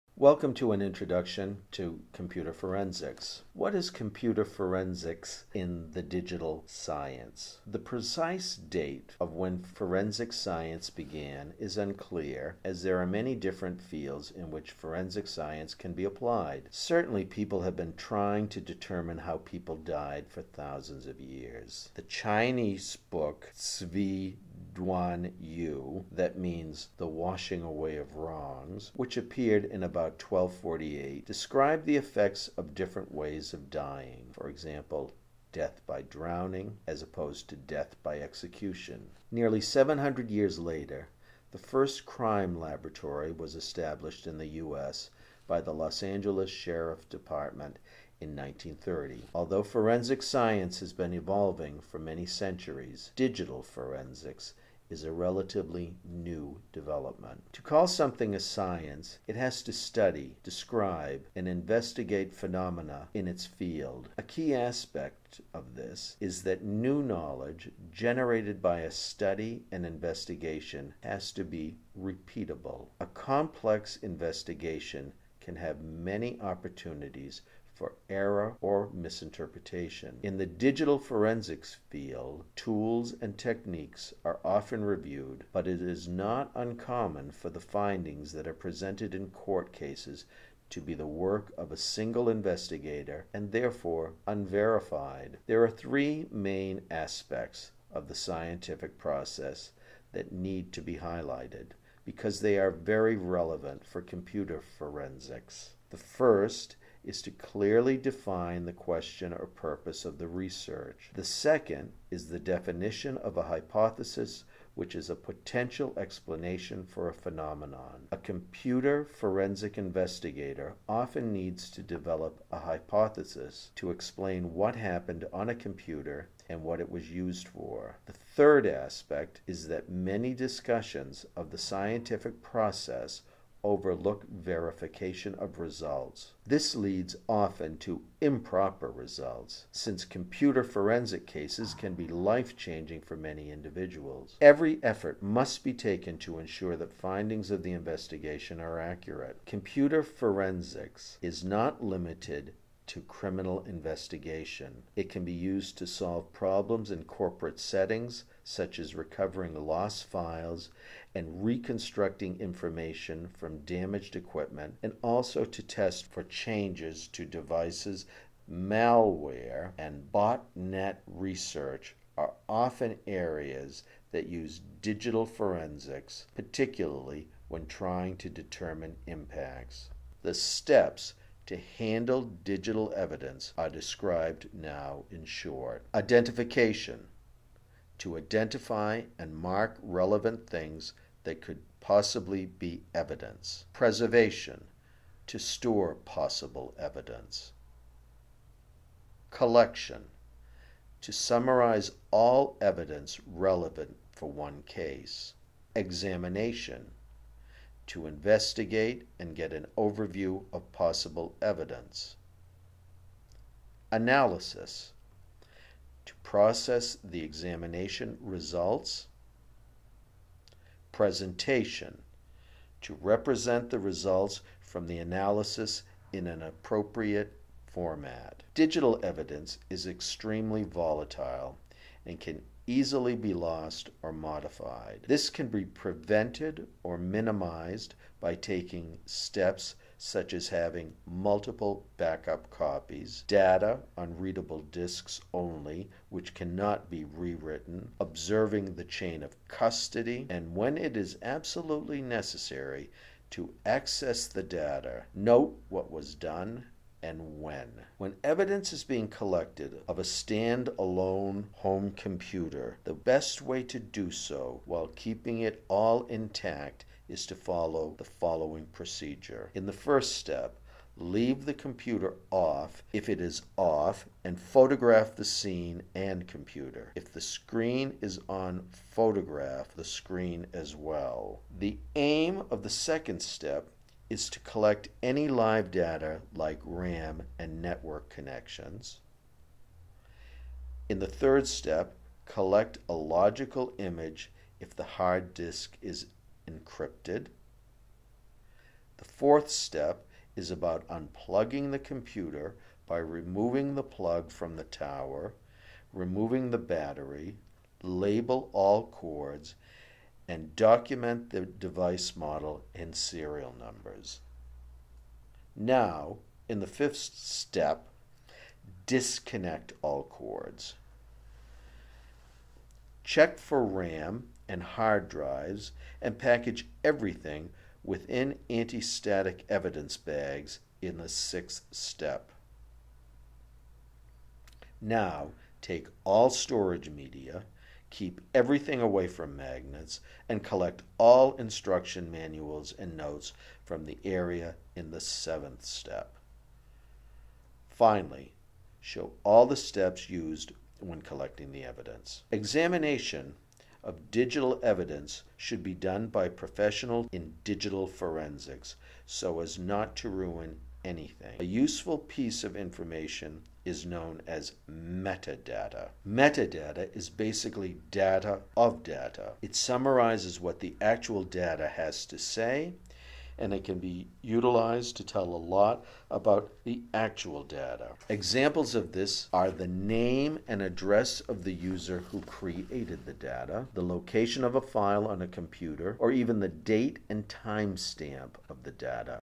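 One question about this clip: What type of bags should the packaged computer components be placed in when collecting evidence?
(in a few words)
anti-static evidence bags.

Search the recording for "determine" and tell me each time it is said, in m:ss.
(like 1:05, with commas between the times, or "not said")
0:18, 2:58.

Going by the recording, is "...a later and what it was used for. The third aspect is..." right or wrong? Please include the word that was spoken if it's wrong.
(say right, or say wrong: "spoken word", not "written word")
wrong: "computer", not "later".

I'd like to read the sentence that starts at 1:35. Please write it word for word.
There are three main aspects of the scientific process that need to be highlighted because they are very relevant for computer forensics.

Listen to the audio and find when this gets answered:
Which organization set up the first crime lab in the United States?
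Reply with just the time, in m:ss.
0:45.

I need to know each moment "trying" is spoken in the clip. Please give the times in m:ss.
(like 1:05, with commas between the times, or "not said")
0:17, 2:57.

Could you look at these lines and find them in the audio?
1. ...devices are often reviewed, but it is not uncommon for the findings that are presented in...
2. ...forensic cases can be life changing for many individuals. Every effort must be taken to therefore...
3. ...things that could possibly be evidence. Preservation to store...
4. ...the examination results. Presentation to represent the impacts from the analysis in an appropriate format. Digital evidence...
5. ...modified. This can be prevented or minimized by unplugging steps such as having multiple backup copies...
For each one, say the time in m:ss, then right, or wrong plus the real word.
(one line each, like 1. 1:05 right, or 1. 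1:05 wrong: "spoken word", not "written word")
1. 1:23 wrong: "techniques", not "devices"
2. 2:20 wrong: "ensure", not "therefore"
3. 3:10 right
4. 3:37 wrong: "results", not "impacts"
5. 3:54 wrong: "taking", not "unplugging".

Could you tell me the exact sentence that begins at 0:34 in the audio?
For example, death by drowning as opposed to death by execution.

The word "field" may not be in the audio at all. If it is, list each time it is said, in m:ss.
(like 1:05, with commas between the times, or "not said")
0:13, 1:03, 1:21.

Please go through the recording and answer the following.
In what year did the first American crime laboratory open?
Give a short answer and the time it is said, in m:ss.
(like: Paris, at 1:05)
1930, at 0:48.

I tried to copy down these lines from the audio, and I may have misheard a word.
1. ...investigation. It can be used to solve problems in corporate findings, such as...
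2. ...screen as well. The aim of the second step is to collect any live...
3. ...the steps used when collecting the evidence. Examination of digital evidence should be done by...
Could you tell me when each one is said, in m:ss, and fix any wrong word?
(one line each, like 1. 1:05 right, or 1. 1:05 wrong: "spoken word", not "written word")
1. 2:33 wrong: "settings", not "findings"
2. 4:39 right
3. 5:49 right.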